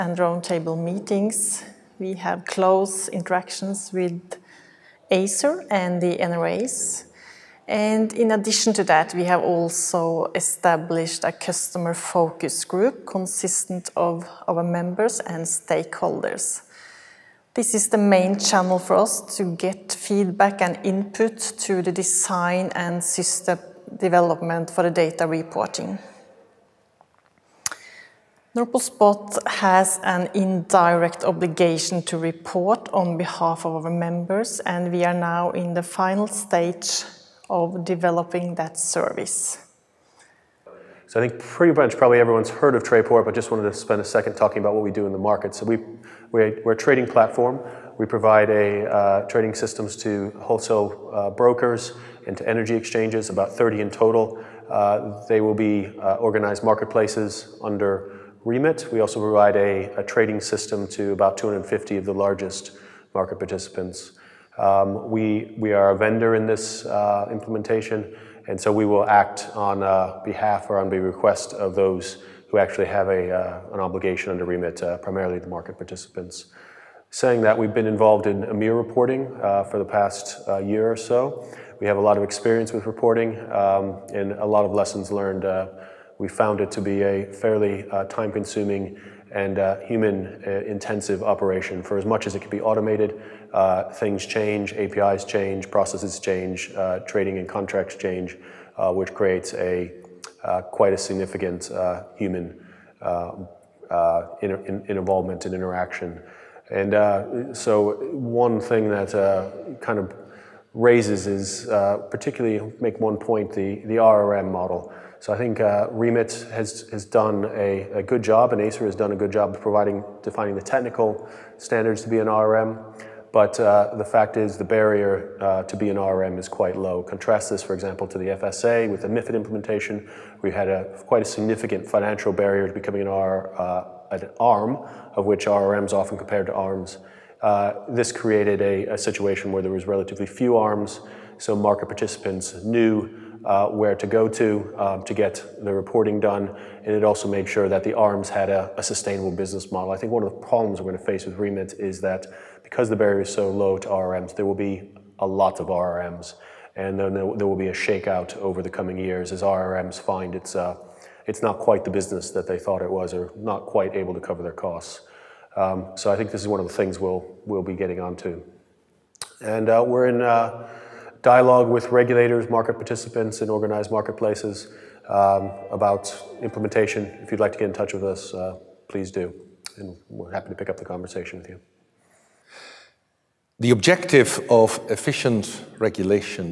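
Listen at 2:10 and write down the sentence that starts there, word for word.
We had a, quite a significant financial barrier to becoming an, R, uh, an ARM, of which RRMs often compared to ARMs.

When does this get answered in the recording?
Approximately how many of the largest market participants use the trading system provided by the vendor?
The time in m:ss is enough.
1:01.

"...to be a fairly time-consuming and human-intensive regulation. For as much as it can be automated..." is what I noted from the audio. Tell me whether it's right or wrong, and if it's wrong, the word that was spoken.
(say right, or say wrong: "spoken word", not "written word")
wrong: "operation", not "regulation".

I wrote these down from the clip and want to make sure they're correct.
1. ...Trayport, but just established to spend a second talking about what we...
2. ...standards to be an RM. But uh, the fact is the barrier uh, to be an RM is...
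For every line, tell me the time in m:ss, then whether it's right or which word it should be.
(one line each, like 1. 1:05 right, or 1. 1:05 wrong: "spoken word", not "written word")
1. 0:42 wrong: "wanted", not "established"
2. 2:01 right.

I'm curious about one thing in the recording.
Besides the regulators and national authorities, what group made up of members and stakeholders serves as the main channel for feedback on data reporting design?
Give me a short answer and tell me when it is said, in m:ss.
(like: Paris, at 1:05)
customer focus group, at 0:11.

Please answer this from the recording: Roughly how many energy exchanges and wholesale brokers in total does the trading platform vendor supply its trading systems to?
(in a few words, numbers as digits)
about 30.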